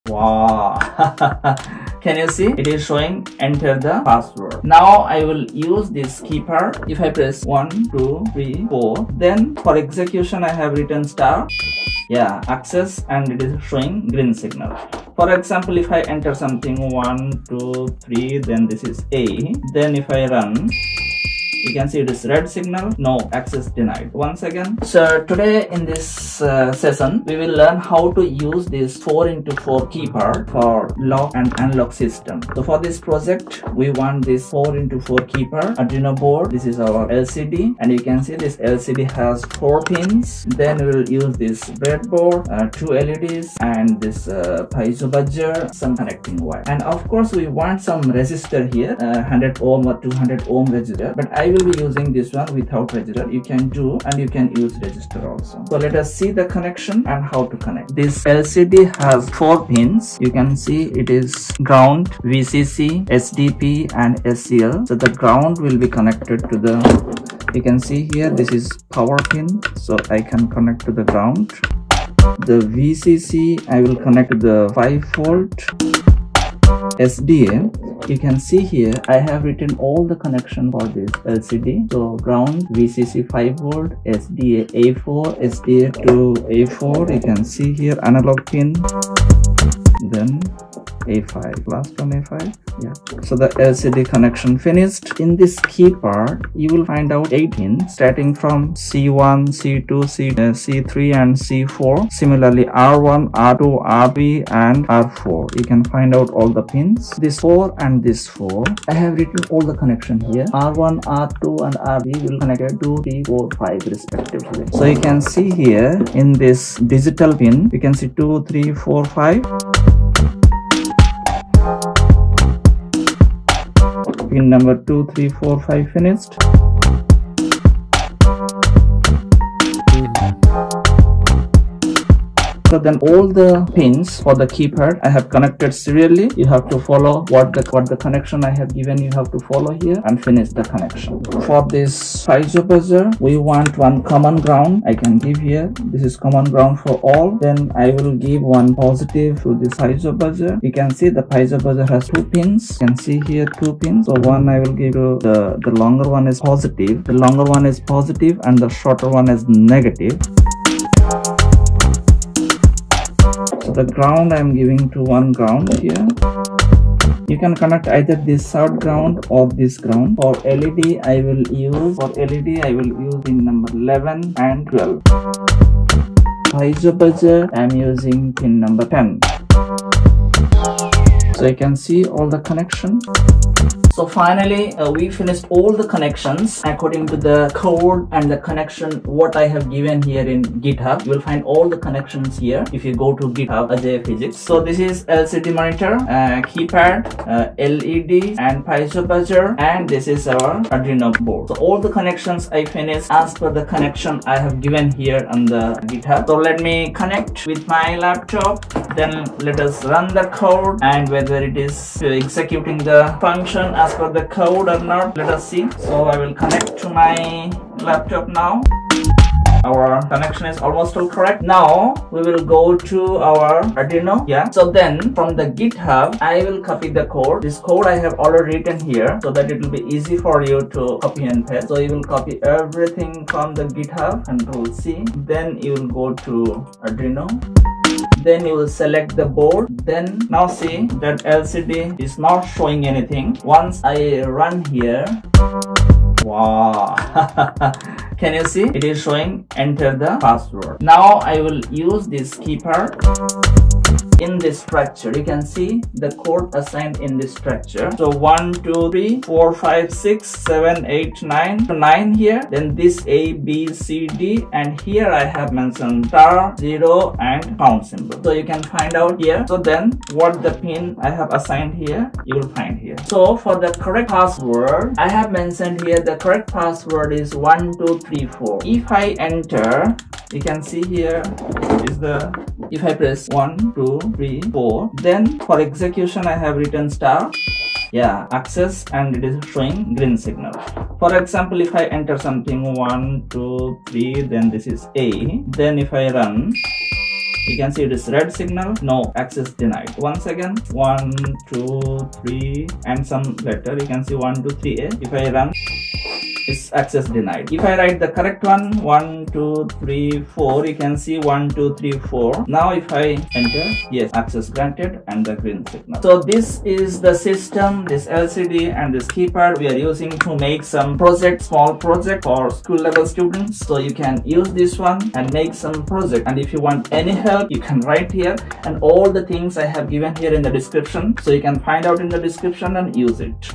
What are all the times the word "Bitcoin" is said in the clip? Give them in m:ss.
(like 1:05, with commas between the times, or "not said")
not said.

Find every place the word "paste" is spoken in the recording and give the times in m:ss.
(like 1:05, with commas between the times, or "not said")
3:51.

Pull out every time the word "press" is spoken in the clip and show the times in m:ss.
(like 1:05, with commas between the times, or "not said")
0:07, 4:42.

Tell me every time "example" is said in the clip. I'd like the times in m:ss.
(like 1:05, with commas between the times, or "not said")
0:15, 4:51.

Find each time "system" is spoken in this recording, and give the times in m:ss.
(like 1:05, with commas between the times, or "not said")
0:31, 5:17.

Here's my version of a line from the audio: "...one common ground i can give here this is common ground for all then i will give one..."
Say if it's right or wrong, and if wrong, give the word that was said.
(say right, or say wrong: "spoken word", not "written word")
right.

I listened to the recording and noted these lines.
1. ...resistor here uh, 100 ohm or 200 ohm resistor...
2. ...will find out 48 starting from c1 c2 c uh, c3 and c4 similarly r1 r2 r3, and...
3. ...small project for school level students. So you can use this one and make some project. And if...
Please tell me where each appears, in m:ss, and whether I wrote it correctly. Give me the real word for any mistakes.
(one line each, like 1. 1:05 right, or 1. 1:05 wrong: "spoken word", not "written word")
1. 0:48 right
2. 1:36 wrong: "18", not "48"
3. 5:21 right.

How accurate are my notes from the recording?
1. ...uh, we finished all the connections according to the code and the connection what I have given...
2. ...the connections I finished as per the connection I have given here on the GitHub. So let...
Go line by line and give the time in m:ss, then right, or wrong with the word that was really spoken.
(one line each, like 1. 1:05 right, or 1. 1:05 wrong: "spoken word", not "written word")
1. 3:04 right
2. 3:21 right.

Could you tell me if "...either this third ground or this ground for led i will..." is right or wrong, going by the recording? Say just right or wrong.
right.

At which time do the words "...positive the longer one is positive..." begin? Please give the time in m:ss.
2:36.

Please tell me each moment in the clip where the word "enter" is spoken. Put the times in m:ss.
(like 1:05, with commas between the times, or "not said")
0:03, 0:16, 4:09, 4:39, 4:51, 5:13.